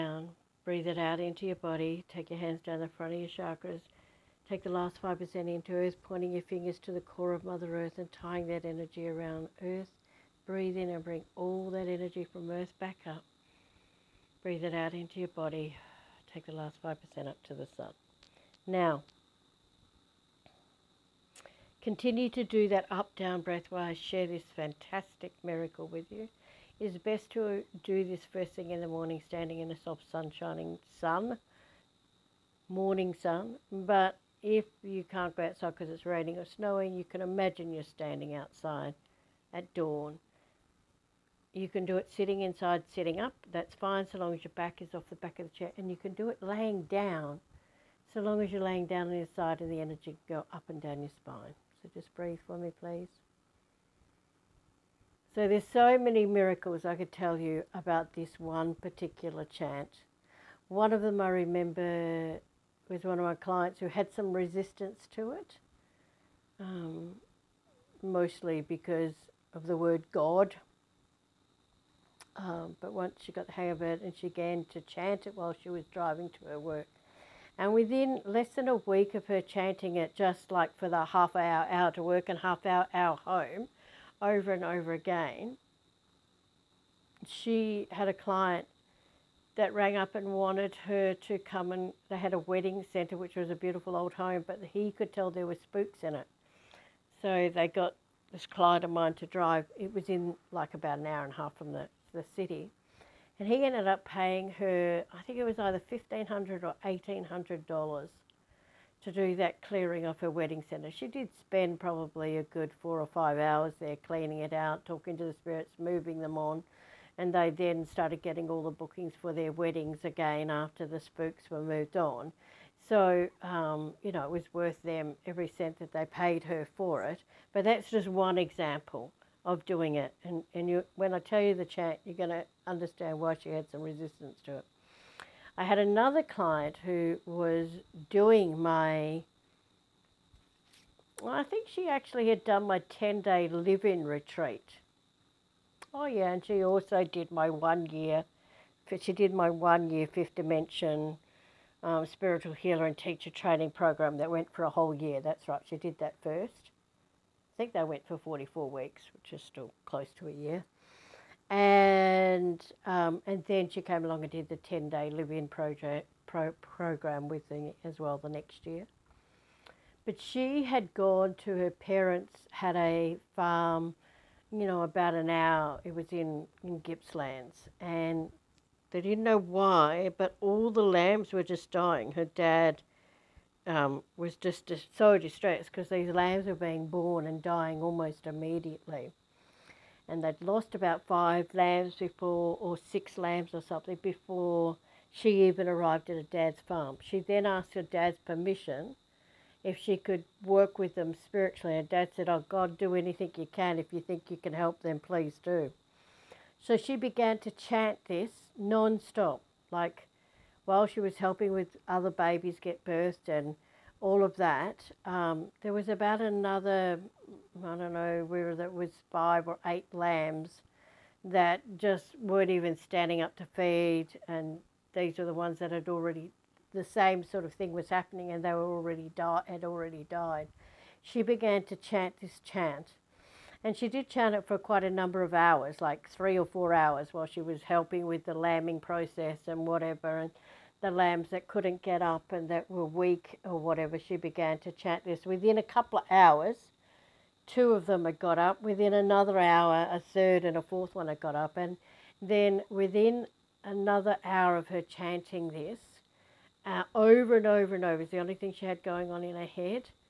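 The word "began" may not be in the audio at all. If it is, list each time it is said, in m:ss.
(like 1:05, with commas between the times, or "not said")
1:14, 3:26, 3:51, 4:04.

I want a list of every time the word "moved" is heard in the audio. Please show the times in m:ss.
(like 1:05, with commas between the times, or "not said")
2:01.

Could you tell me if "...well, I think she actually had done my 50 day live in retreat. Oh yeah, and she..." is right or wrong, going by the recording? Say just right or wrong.
wrong.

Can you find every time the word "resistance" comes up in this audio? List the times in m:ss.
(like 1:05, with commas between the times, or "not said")
1:04, 2:13.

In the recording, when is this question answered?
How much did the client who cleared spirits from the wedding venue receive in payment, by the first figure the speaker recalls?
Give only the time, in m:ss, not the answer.
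1:45.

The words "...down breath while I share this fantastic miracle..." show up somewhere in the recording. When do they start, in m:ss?
0:23.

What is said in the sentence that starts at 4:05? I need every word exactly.
Within a couple of hours, two of them had got up.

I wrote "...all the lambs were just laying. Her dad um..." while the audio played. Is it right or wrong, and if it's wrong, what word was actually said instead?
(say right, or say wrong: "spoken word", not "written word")
wrong: "dying", not "laying".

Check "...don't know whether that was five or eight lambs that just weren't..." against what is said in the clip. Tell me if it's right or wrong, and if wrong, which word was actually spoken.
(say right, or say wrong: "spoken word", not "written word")
right.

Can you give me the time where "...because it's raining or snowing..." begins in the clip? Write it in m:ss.
0:35.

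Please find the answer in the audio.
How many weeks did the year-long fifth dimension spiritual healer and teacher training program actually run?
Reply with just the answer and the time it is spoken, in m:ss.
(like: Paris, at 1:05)
44, at 2:38.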